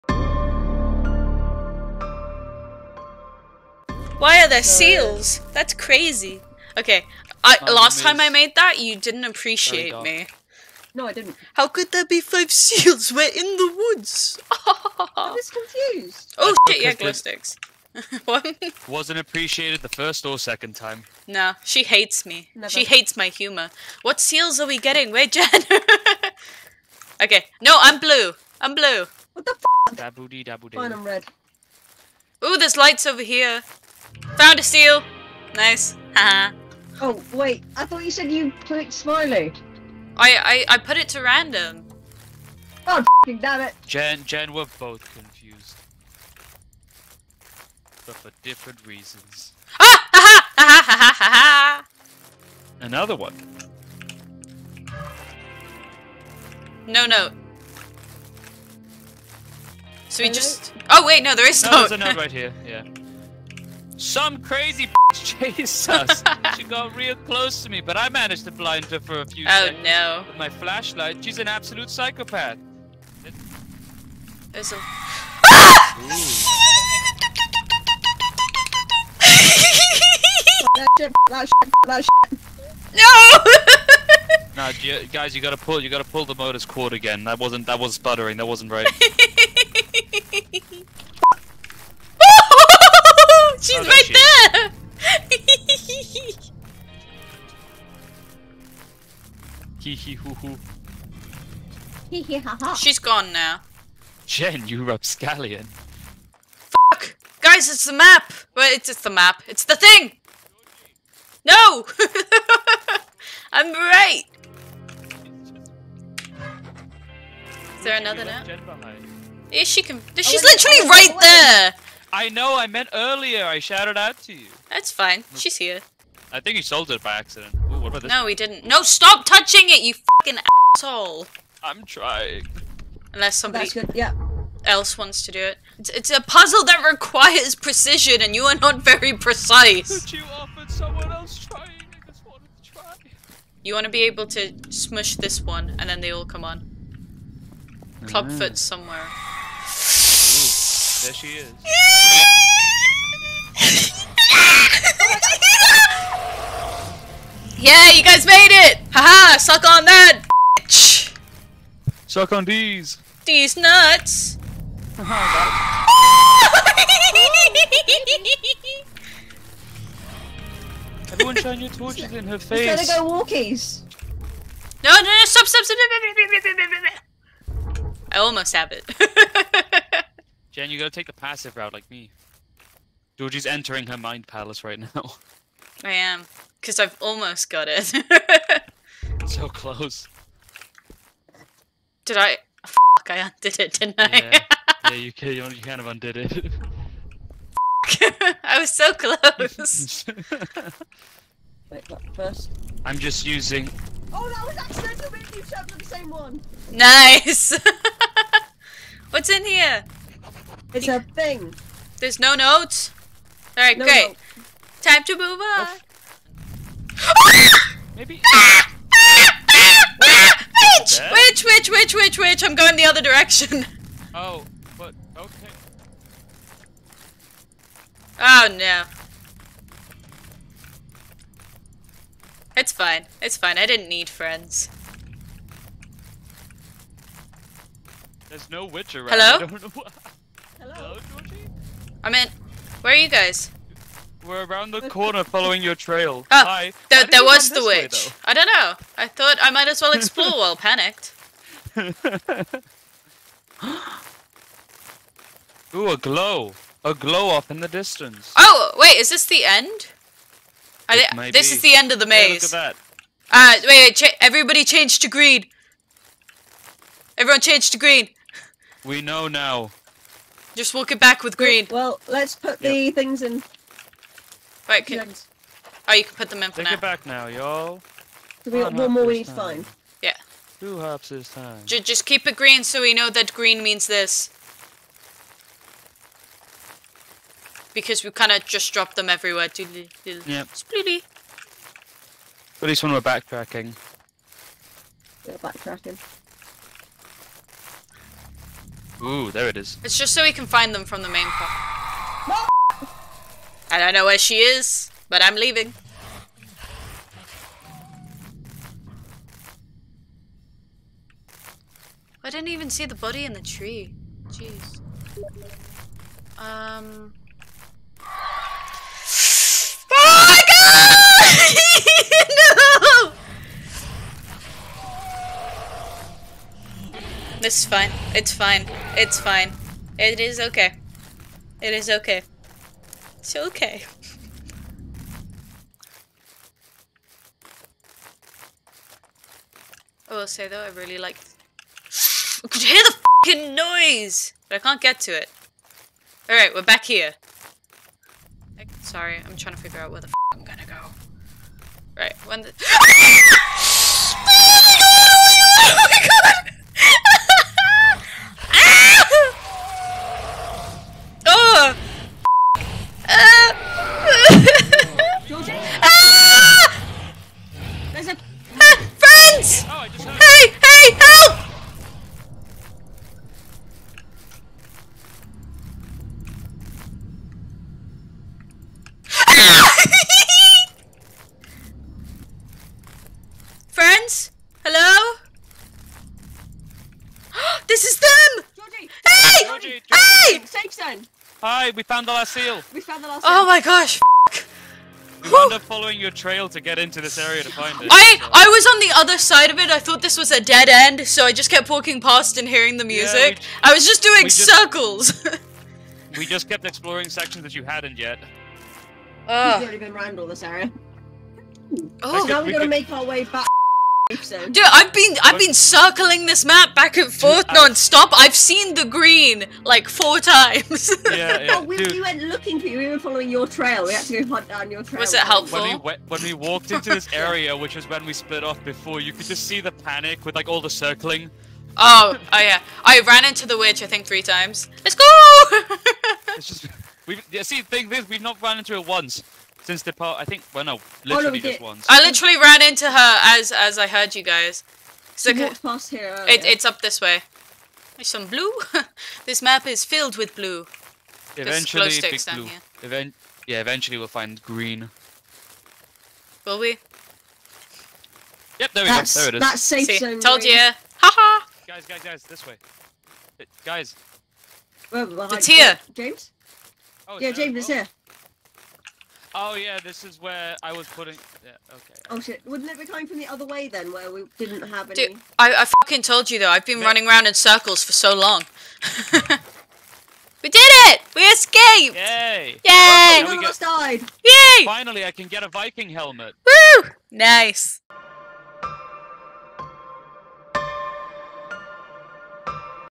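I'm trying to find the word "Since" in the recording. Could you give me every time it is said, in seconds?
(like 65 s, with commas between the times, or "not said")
439 s.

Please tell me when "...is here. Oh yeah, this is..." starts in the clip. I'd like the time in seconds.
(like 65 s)
467 s.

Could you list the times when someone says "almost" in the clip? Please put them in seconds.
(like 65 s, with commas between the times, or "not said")
178 s, 187 s.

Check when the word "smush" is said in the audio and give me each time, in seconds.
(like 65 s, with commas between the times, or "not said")
144 s.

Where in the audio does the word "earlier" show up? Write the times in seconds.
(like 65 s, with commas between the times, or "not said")
122 s, 446 s.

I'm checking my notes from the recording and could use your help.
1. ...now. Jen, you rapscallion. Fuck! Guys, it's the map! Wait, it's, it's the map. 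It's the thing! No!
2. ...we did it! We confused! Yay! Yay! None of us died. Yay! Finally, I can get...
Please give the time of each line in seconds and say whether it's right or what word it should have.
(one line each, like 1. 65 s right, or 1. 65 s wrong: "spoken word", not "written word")
1. 103 s right
2. 480 s wrong: "escaped", not "confused".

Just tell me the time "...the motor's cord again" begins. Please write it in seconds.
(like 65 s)
86 s.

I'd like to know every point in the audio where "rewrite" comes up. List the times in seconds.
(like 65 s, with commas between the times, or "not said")
not said.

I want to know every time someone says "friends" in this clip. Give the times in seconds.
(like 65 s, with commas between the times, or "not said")
234 s.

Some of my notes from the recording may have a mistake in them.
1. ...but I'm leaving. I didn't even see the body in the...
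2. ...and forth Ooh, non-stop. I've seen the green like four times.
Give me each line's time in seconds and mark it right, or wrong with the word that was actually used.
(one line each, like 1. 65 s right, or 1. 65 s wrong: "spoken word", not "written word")
1. 305 s right
2. 416 s wrong: "Dude", not "Ooh".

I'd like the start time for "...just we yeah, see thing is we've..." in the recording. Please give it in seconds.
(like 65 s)
436 s.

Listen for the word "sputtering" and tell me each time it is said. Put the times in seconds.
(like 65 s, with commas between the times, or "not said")
87 s.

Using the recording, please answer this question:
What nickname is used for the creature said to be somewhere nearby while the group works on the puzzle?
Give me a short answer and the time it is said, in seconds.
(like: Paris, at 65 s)
Clubfoot, at 148 s.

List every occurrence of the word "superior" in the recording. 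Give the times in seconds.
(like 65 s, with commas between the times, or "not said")
not said.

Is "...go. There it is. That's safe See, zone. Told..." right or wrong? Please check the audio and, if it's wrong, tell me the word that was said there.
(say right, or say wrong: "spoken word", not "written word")
right.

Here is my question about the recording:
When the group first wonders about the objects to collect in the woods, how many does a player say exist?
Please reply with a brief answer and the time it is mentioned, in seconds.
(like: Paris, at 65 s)
5, at 12 s.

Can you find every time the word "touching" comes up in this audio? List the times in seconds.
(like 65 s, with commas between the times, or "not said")
129 s.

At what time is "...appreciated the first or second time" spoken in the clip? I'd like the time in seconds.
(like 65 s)
19 s.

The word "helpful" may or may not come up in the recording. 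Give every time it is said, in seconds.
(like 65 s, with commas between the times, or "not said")
425 s.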